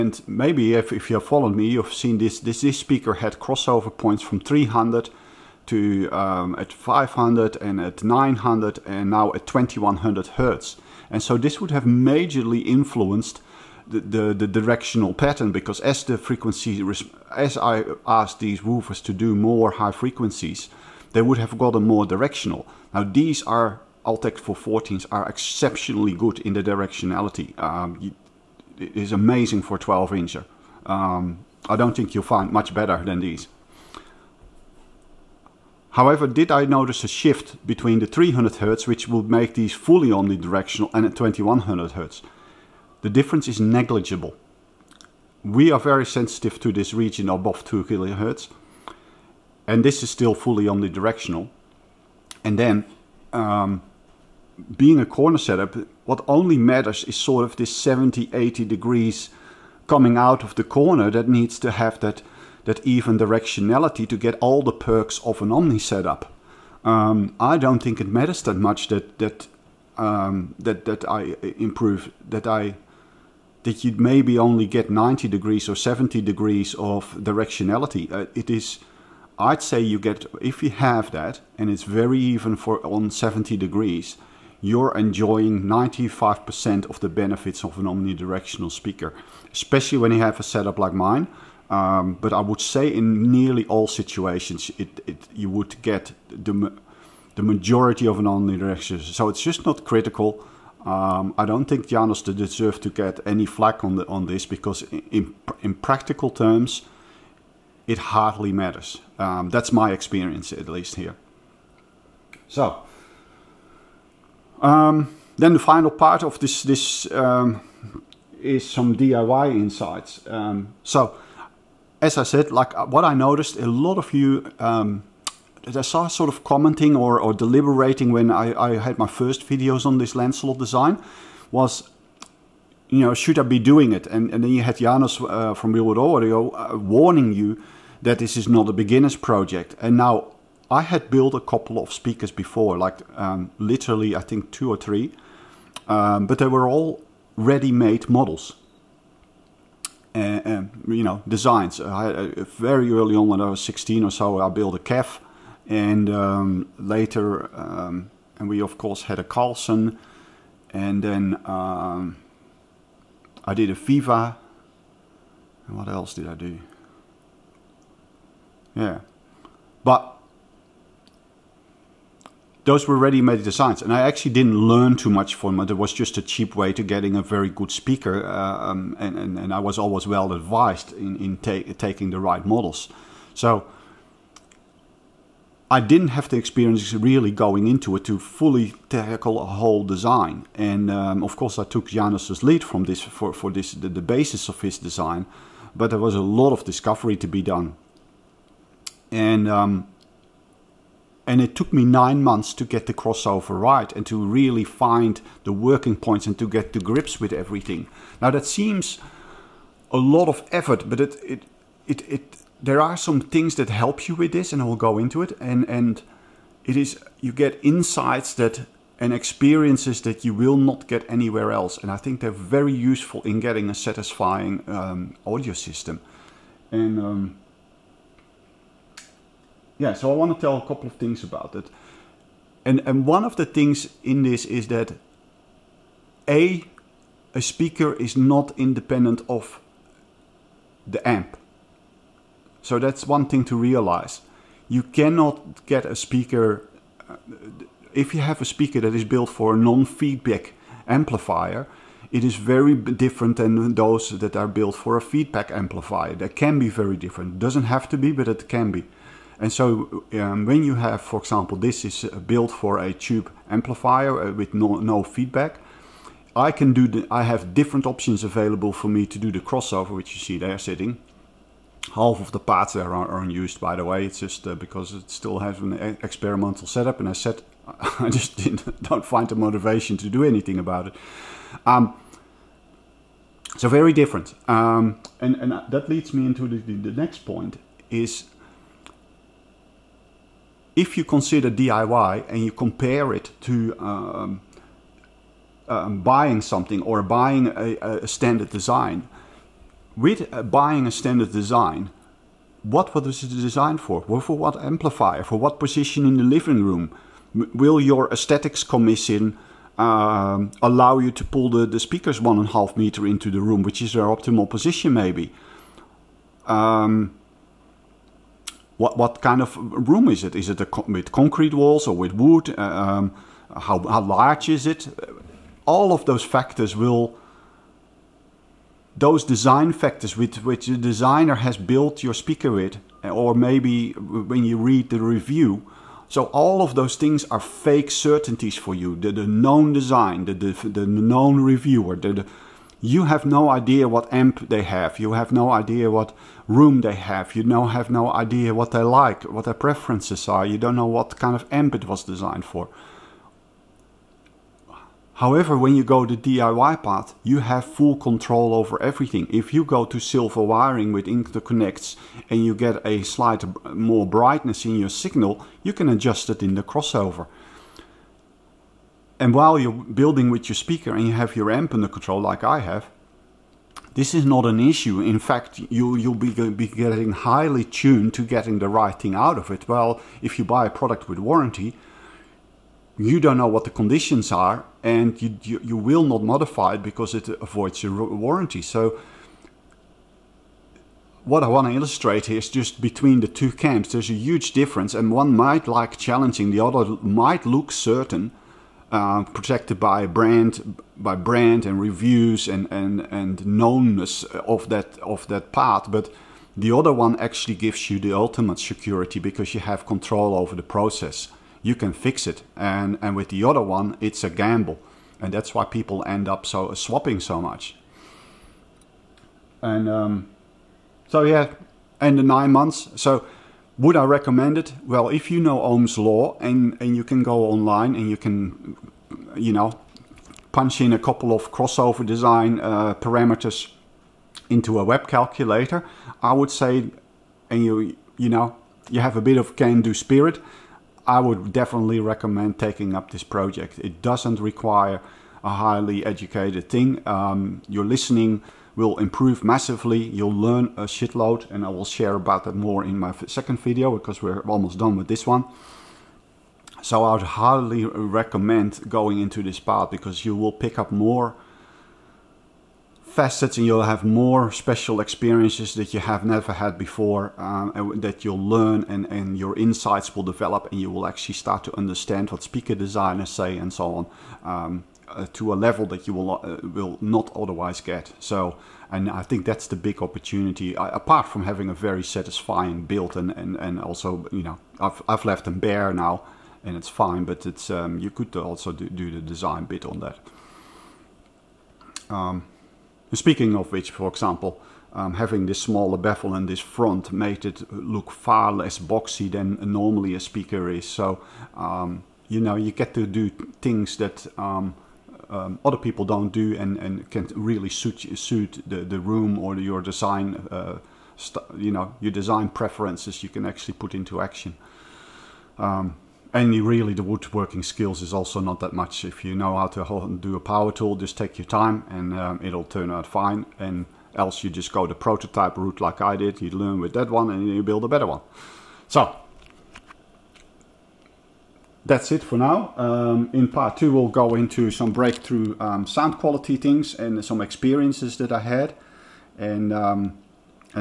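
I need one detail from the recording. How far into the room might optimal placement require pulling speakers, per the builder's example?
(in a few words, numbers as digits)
1.5 meters.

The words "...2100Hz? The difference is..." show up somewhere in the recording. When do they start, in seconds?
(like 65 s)
41 s.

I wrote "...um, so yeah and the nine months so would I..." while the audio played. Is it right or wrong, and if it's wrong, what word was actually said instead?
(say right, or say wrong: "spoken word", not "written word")
right.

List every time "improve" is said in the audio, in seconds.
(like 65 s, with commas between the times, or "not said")
71 s, 448 s.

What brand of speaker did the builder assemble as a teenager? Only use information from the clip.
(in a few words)
KEF.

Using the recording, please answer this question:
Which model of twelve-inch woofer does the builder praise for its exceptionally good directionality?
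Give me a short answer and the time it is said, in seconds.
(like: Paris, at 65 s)
Altec 414, at 24 s.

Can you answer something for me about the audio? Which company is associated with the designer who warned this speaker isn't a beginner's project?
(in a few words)
Real World Audio.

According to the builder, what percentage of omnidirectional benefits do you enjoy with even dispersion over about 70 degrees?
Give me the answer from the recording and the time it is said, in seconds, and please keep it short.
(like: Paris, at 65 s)
95%, at 85 s.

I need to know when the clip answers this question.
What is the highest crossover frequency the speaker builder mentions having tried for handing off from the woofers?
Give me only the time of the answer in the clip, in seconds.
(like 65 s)
9 s.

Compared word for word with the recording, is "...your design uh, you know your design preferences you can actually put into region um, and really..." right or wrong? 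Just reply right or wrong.
wrong.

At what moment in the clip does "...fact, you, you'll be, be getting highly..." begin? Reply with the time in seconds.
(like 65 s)
375 s.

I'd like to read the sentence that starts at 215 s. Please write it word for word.
And and it is you get insights that and experiences that you will not get anywhere else.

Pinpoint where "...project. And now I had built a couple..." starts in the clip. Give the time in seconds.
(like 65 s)
139 s.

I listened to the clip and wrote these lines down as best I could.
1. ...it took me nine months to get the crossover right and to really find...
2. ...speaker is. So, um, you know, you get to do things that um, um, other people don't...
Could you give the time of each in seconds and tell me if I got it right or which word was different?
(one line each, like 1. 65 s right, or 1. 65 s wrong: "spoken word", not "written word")
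1. 201 s right
2. 500 s right.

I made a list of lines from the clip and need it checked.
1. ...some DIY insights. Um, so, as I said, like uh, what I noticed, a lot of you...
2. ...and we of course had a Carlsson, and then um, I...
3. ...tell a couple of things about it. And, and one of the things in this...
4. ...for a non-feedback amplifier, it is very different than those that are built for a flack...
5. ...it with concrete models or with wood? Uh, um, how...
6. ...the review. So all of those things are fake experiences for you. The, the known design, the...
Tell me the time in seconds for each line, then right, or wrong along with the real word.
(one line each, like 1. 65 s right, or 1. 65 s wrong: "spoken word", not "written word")
1. 118 s right
2. 158 s right
3. 230 s right
4. 249 s wrong: "feedback", not "flack"
5. 320 s wrong: "walls", not "models"
6. 334 s wrong: "certainties", not "experiences".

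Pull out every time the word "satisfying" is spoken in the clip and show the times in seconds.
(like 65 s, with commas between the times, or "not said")
223 s, 482 s.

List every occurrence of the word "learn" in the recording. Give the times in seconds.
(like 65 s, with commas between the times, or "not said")
174 s, 450 s, 468 s, 526 s.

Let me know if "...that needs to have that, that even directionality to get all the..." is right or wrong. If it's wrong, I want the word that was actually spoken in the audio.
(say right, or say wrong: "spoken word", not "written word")
right.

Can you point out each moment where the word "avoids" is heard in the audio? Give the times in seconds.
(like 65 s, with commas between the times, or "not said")
387 s.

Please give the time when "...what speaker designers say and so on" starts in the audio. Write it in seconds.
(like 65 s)
472 s.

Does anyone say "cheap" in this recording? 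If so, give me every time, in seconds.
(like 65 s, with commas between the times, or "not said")
176 s.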